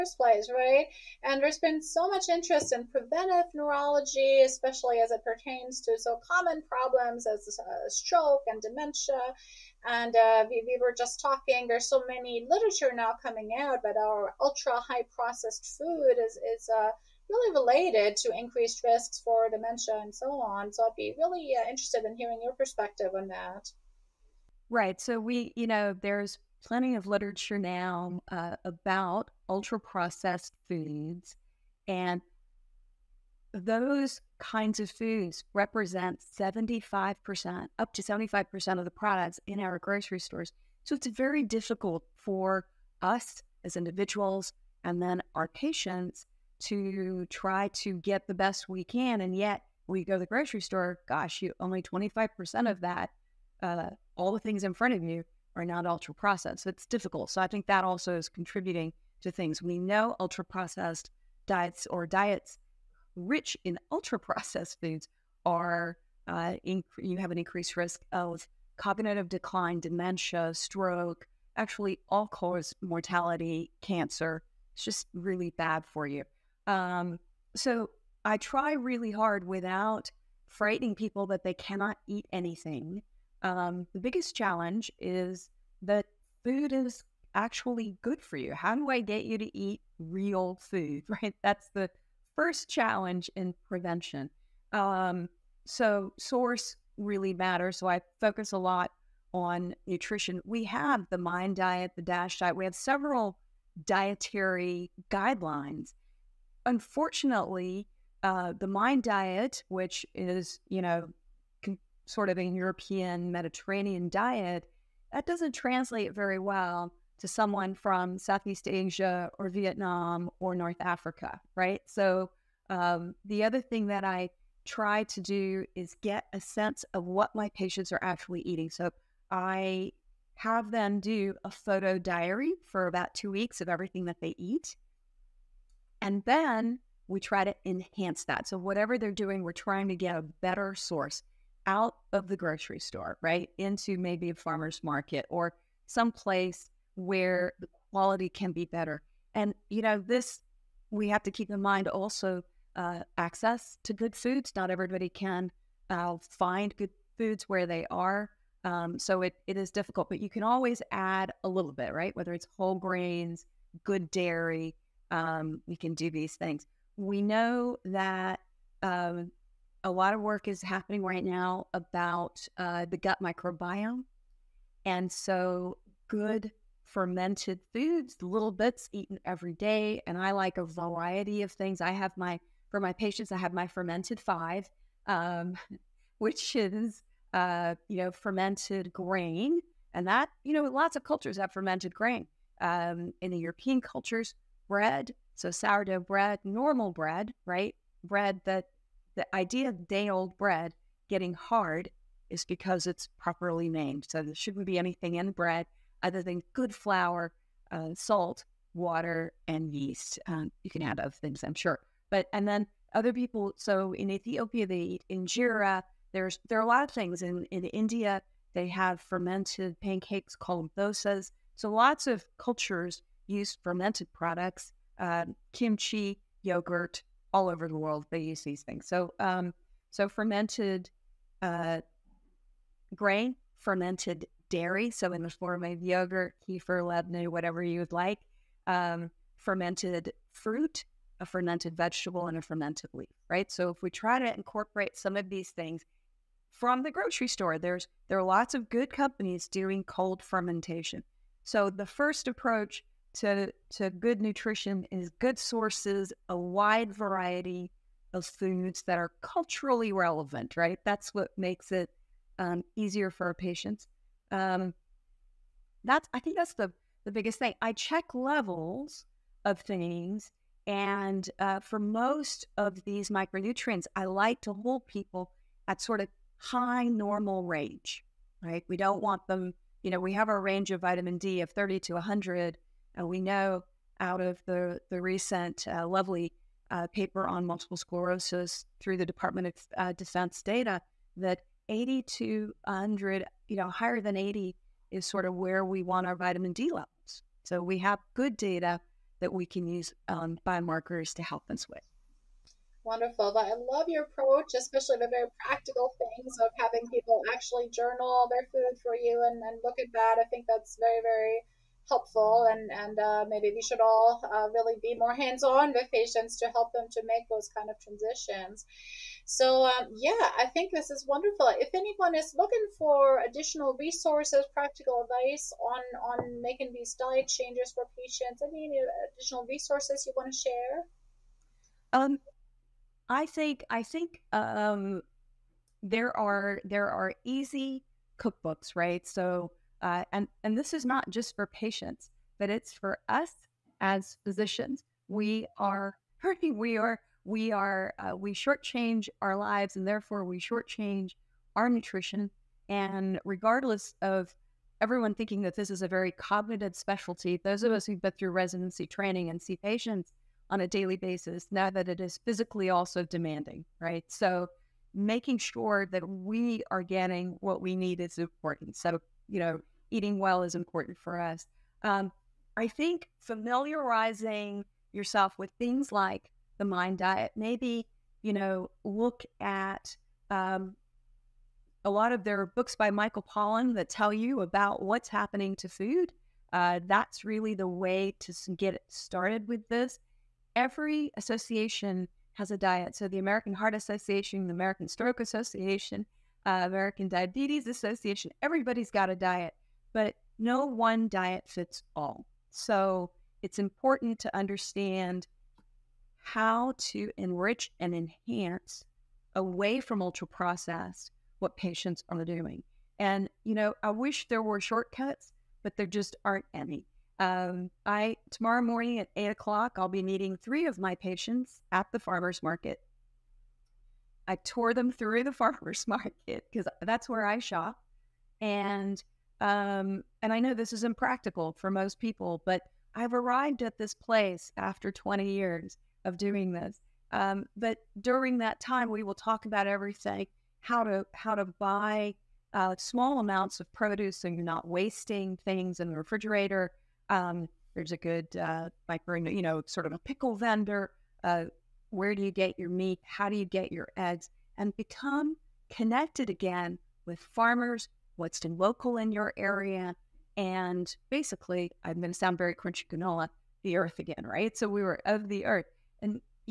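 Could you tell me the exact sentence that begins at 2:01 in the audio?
So um, the other thing that I try to do is get a sense of what my patients are actually eating.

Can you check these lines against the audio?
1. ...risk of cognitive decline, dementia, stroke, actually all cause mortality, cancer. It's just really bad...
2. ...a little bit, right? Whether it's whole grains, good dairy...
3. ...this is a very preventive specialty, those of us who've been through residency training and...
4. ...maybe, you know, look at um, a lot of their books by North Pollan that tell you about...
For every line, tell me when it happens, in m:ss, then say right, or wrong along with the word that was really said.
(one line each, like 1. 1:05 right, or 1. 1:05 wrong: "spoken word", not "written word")
1. 1:07 right
2. 2:41 right
3. 5:55 wrong: "cognitive", not "preventive"
4. 6:17 wrong: "Michael", not "North".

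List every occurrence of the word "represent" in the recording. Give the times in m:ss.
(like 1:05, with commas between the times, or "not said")
0:35.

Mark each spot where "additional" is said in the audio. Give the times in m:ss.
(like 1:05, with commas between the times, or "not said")
5:23, 5:29.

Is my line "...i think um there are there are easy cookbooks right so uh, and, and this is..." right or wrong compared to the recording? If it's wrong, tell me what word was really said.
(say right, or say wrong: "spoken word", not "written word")
right.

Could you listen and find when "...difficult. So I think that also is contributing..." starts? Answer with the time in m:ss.
0:56.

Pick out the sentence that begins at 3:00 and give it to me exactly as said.
And I like a variety of things.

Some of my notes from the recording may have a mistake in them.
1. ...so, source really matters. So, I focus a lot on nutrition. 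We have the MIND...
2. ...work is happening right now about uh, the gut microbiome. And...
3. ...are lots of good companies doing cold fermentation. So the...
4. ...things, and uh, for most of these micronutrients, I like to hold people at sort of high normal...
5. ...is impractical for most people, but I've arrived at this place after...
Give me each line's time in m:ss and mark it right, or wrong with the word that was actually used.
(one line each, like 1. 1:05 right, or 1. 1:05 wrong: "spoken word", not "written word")
1. 1:35 right
2. 2:50 right
3. 4:08 right
4. 4:29 right
5. 7:10 right.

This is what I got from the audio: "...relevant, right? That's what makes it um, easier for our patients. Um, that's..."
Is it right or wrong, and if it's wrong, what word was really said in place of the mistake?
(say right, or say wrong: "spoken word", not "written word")
right.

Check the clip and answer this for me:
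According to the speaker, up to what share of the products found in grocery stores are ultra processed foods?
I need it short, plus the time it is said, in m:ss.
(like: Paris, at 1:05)
75%, at 0:37.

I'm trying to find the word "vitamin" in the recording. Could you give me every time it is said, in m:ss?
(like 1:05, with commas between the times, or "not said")
4:40, 4:56.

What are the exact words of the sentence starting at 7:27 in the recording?
Um, there's a good uh, you know, sort of a pickle vendor.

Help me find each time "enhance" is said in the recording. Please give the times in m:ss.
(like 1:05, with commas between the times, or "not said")
2:17, 6:47.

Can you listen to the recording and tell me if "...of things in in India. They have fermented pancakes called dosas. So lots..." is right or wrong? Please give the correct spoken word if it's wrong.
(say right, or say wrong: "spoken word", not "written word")
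right.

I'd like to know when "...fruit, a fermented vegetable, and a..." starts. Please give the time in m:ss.
4:00.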